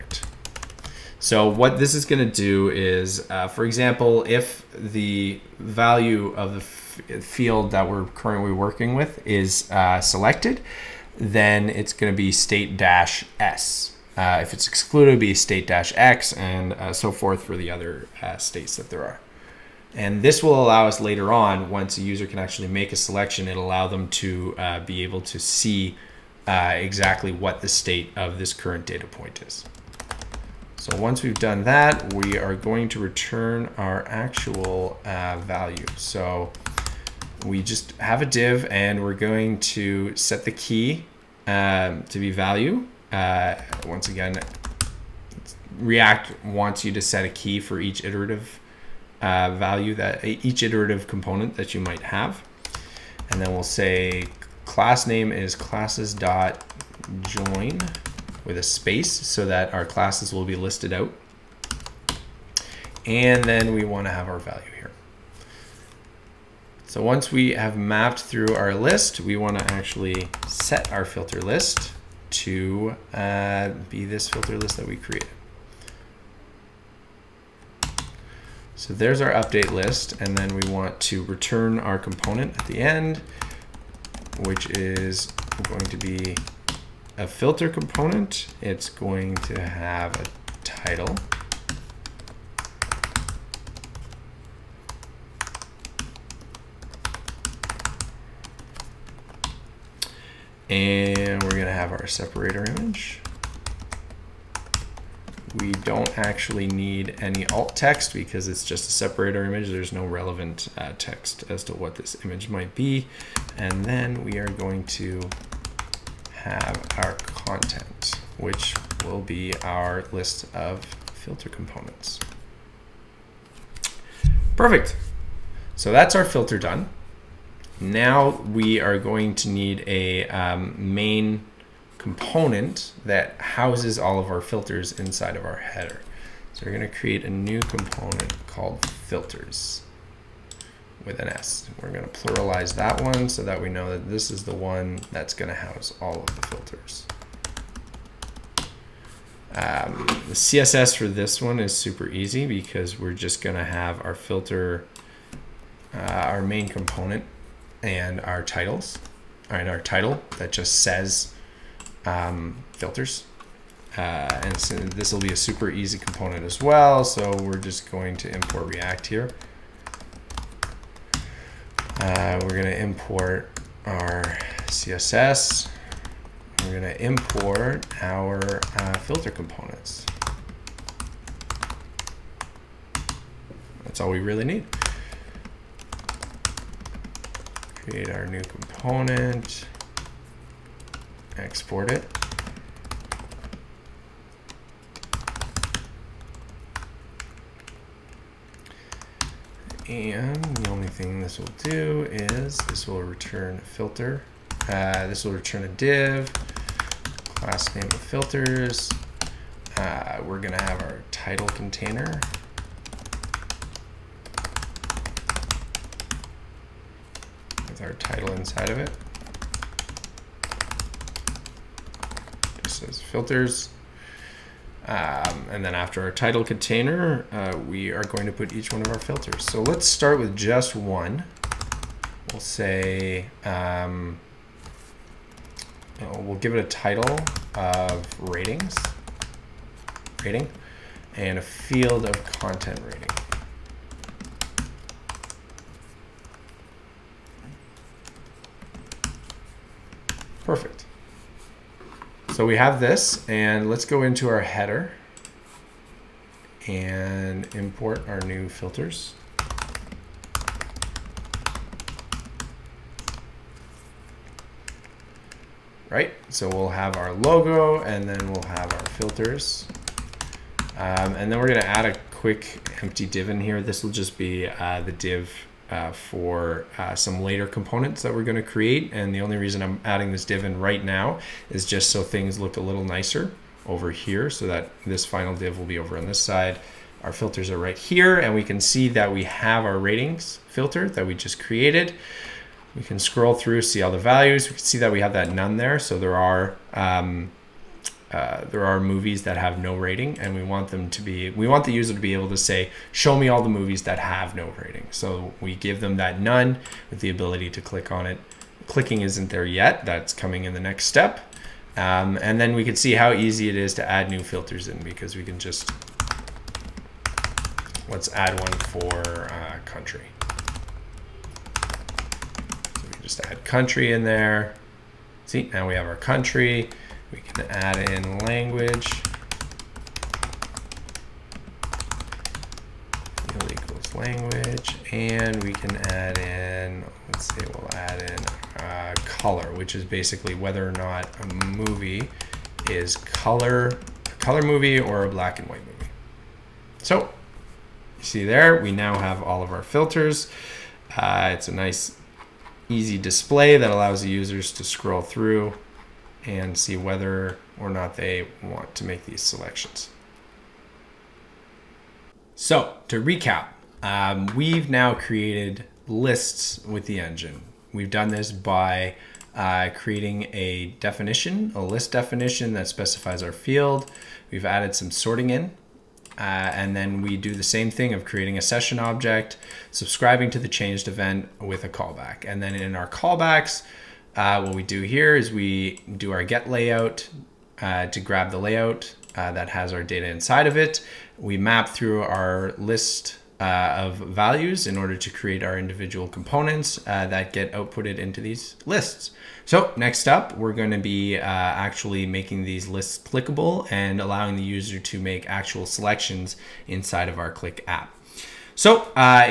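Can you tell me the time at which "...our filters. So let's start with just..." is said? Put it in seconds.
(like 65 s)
228 s.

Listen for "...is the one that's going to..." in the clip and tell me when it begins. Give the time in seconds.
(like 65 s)
144 s.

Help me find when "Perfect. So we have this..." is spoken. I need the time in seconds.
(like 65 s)
250 s.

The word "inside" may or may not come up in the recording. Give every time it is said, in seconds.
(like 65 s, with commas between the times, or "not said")
134 s, 218 s, 390 s, 406 s.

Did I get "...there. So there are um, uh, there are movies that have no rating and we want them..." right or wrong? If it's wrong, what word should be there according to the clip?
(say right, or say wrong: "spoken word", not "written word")
right.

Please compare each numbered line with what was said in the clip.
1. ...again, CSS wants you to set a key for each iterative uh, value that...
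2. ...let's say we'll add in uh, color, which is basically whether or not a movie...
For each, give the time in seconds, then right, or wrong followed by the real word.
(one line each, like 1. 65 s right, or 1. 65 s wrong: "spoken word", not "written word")
1. 44 s wrong: "React", not "CSS"
2. 337 s right.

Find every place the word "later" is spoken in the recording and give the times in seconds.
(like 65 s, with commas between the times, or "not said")
20 s, 277 s.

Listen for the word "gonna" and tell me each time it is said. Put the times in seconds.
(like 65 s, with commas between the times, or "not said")
210 s, 271 s.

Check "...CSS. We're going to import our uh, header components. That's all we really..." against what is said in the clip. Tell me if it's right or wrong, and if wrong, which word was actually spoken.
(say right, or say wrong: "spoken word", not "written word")
wrong: "filter", not "header".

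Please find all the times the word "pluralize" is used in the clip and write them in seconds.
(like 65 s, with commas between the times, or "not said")
142 s.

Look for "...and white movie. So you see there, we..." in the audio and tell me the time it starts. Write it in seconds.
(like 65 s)
345 s.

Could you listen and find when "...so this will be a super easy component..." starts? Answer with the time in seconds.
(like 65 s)
164 s.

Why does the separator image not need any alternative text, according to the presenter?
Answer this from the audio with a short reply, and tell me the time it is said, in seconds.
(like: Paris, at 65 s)
just a separator image, at 108 s.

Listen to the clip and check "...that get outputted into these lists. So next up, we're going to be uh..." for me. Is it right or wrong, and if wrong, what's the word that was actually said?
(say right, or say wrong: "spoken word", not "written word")
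right.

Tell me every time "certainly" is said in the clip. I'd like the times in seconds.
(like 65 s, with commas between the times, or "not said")
not said.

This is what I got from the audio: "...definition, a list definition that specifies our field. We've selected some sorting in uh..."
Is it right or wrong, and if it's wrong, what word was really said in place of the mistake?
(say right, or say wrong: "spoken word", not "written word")
wrong: "added", not "selected".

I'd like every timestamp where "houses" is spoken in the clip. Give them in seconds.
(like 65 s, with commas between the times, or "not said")
133 s, 145 s.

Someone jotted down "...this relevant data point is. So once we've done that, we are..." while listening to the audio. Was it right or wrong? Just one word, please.
wrong.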